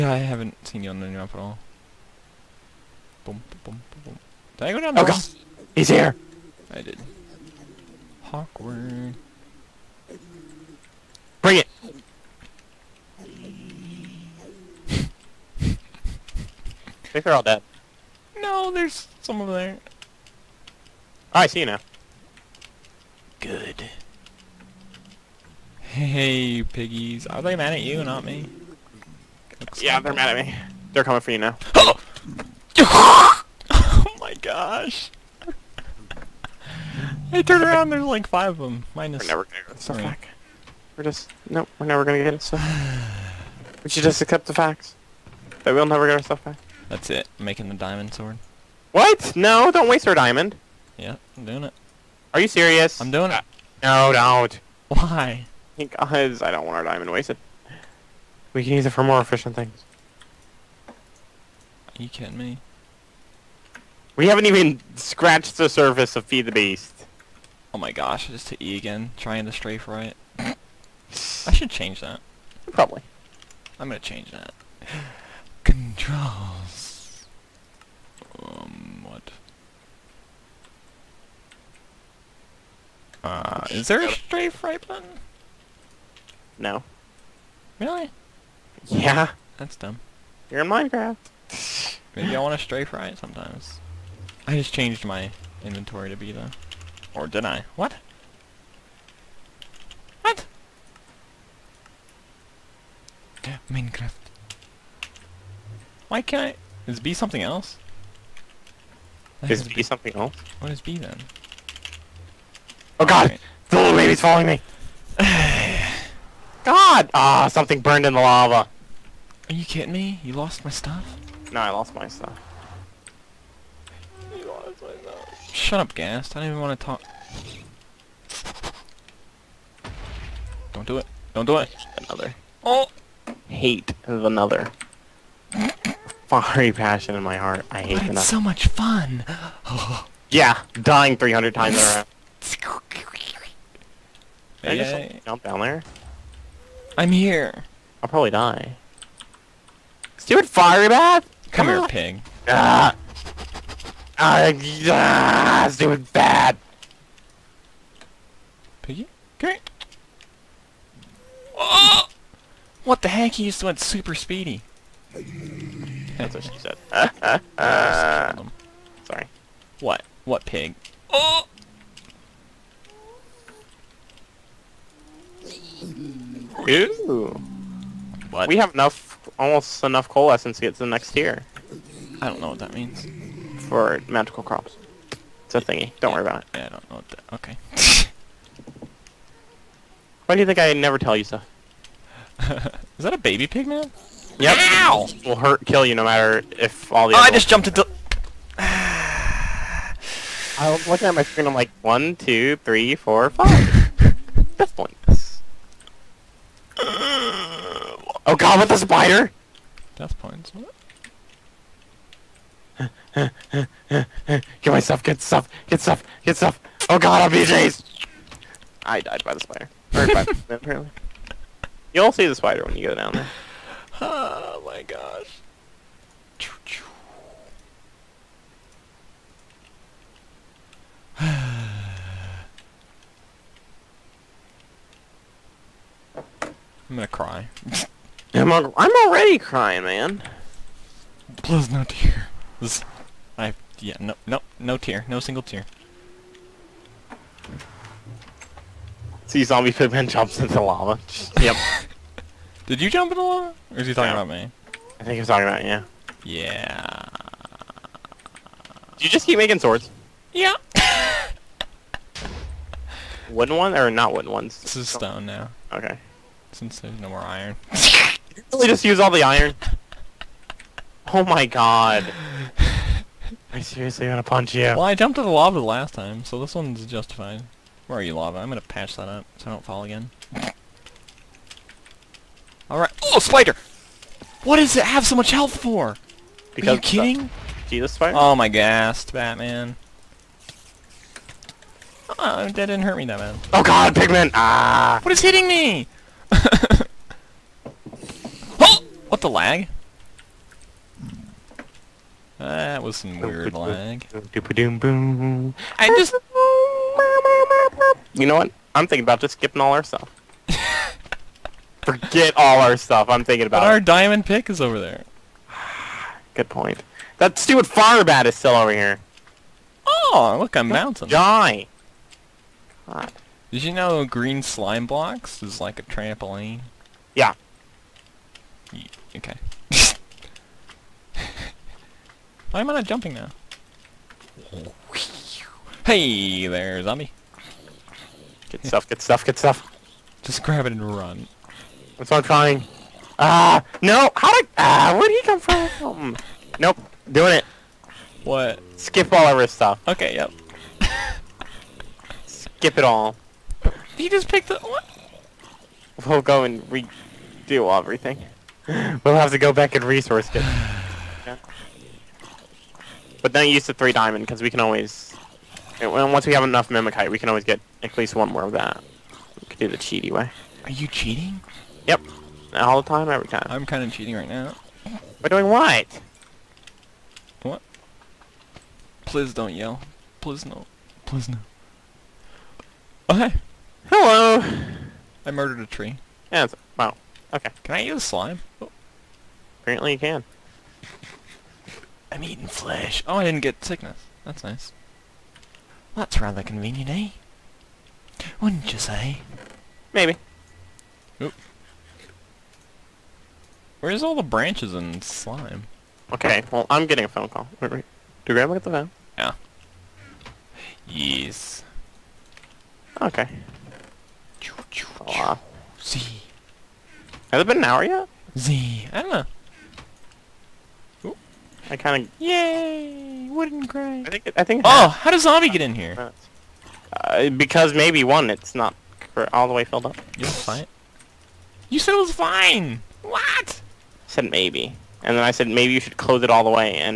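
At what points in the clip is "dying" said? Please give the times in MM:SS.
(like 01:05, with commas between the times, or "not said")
02:20.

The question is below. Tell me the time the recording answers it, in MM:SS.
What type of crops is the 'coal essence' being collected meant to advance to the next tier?
03:04.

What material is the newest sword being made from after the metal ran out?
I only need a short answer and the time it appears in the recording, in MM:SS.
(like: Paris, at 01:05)
Stone, at 04:24.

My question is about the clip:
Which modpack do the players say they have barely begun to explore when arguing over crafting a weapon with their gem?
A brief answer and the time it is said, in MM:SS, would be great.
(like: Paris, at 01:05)
Feed the Beast, at 01:06.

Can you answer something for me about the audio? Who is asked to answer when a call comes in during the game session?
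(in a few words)
Grandma.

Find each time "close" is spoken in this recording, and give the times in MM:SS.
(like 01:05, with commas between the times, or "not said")
07:15.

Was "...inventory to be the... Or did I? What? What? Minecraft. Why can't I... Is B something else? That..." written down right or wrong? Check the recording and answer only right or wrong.
right.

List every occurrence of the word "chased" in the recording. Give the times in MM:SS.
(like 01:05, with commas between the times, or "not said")
03:37.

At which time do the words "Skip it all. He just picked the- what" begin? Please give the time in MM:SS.
05:52.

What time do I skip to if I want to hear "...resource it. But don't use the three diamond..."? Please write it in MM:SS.
05:59.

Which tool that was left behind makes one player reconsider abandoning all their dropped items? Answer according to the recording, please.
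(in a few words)
Diamond pick.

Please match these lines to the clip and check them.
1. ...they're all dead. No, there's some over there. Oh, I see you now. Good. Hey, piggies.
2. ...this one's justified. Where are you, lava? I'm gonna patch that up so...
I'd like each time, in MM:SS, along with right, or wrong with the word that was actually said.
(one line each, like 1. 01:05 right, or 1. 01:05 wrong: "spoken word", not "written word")
1. 00:17 right
2. 04:36 right.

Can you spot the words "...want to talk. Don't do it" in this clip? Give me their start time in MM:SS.
02:06.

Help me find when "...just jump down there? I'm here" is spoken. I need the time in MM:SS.
02:24.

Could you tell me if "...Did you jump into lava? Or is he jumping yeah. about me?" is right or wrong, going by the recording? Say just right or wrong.
wrong.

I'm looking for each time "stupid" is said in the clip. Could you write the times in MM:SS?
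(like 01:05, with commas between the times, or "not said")
02:30, 02:35, 05:17.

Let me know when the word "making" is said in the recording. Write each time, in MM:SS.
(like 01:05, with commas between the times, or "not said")
00:47, 04:19.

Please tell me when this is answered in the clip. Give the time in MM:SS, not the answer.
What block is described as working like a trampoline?
05:24.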